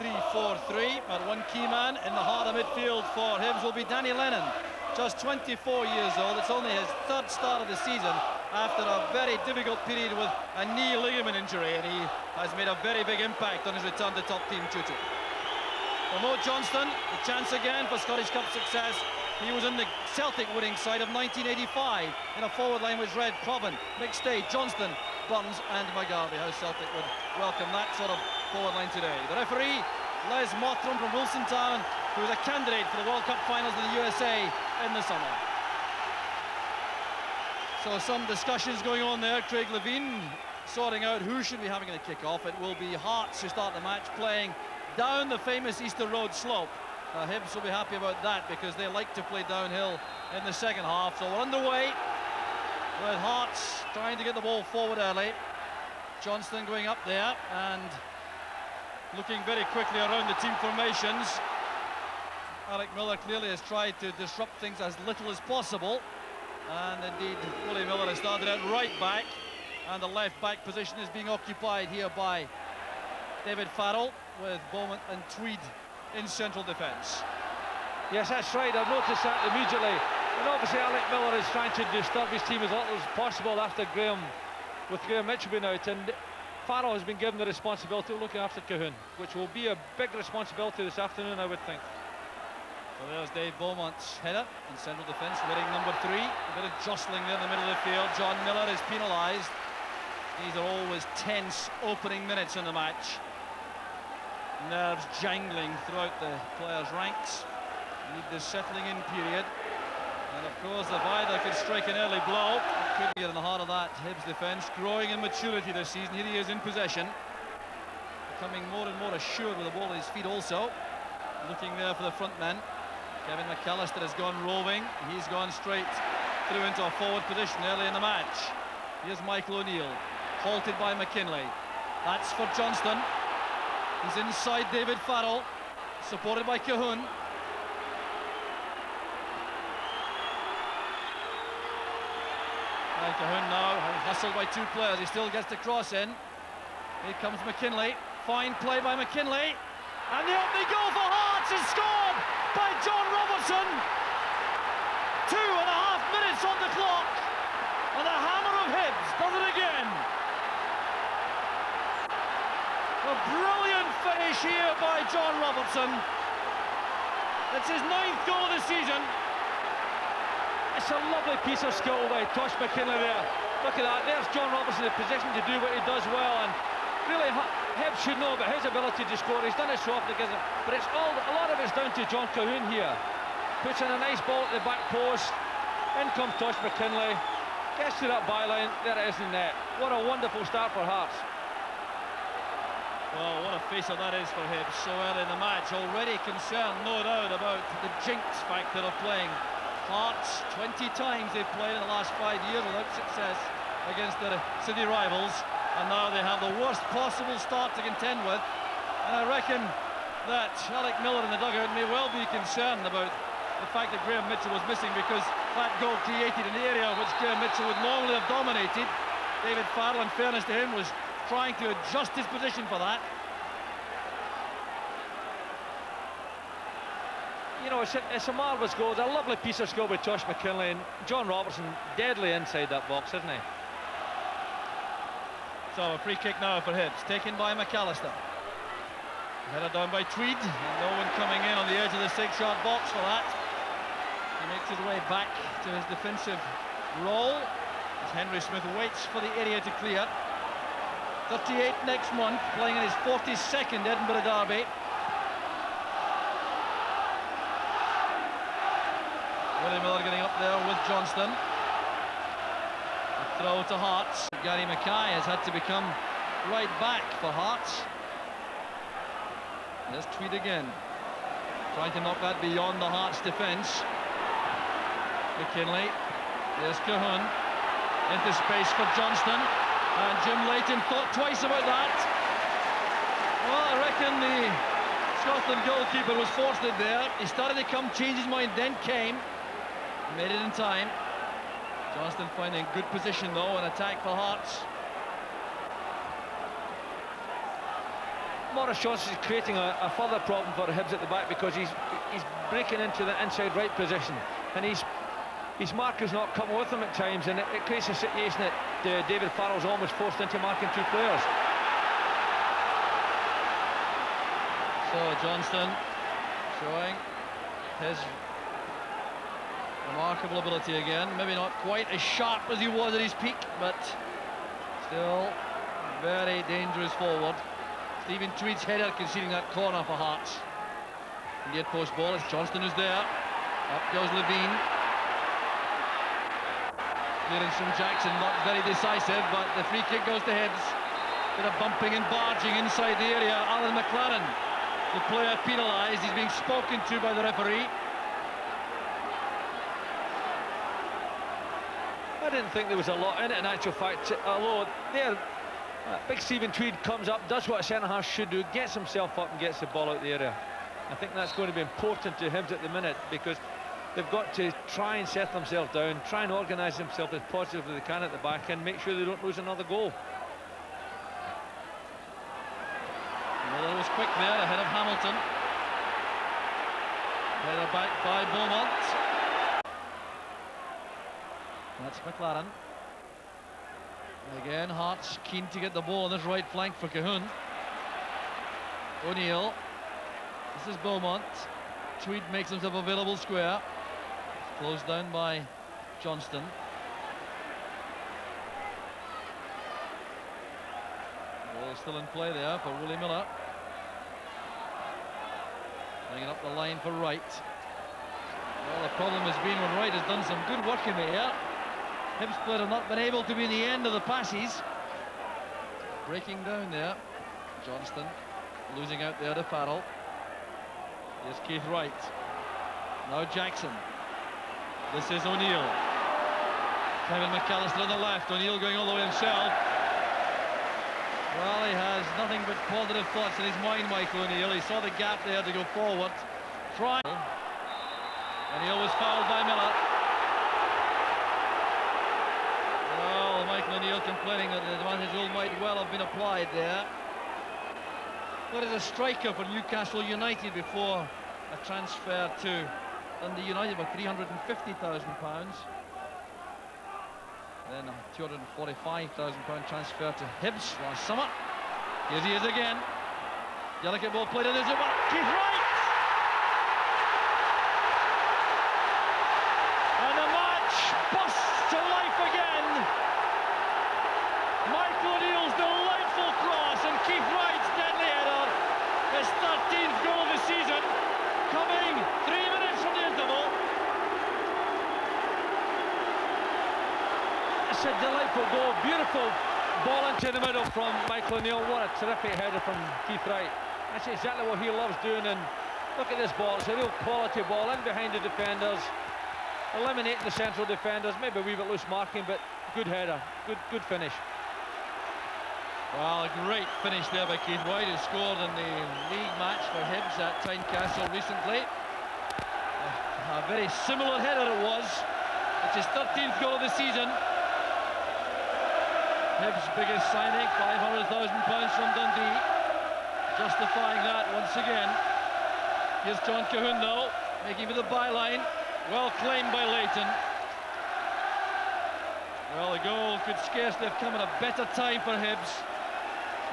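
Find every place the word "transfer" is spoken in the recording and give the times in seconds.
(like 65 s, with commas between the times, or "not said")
451 s, 459 s.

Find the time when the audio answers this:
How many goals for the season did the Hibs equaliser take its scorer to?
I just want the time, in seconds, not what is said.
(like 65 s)
515 s.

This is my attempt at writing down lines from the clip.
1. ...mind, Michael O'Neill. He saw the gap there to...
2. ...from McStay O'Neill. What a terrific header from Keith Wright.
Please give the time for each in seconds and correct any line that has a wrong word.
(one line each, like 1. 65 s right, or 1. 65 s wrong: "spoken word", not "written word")
1. 433 s right
2. 490 s wrong: "Michael", not "McStay".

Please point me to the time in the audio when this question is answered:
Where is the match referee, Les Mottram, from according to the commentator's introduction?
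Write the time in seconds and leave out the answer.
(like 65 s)
31 s.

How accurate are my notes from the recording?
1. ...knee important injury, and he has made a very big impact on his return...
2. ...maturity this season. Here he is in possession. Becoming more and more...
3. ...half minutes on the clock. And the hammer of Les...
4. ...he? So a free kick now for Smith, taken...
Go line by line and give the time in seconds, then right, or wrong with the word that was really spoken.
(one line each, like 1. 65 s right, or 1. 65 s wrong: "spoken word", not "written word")
1. 10 s wrong: "ligament", not "important"
2. 115 s right
3. 155 s wrong: "Hibs", not "Les"
4. 233 s wrong: "Hibs", not "Smith".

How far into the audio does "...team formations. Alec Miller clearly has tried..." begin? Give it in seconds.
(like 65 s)
60 s.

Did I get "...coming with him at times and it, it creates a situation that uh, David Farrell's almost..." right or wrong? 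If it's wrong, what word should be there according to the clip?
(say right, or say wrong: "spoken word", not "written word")
right.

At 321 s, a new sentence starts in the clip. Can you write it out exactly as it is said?
Maybe not quite as sharp as he was at his peak, but still very dangerous forward.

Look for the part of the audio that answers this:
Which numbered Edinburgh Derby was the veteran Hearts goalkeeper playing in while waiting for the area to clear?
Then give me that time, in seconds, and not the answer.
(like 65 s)
253 s.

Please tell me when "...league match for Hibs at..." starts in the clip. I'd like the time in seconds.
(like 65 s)
509 s.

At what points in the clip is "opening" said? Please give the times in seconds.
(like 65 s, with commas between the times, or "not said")
101 s, 150 s.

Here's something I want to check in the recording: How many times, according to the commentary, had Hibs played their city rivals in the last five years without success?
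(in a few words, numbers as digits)
20.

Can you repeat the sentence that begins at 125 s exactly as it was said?
He's gone straight through into a forward position early in the match.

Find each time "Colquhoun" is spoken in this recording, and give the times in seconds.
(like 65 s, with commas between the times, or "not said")
88 s, 136 s, 143 s, 182 s, 276 s, 386 s, 526 s.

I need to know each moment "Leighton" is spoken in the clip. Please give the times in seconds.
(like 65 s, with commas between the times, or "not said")
280 s, 529 s.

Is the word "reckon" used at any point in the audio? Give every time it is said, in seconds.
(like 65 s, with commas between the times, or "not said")
209 s, 283 s.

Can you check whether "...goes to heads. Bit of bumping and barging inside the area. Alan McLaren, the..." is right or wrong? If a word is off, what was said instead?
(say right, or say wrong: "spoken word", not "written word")
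right.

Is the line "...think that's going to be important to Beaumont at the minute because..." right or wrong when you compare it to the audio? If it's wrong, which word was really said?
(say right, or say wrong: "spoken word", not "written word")
wrong: "Hibs", not "Beaumont".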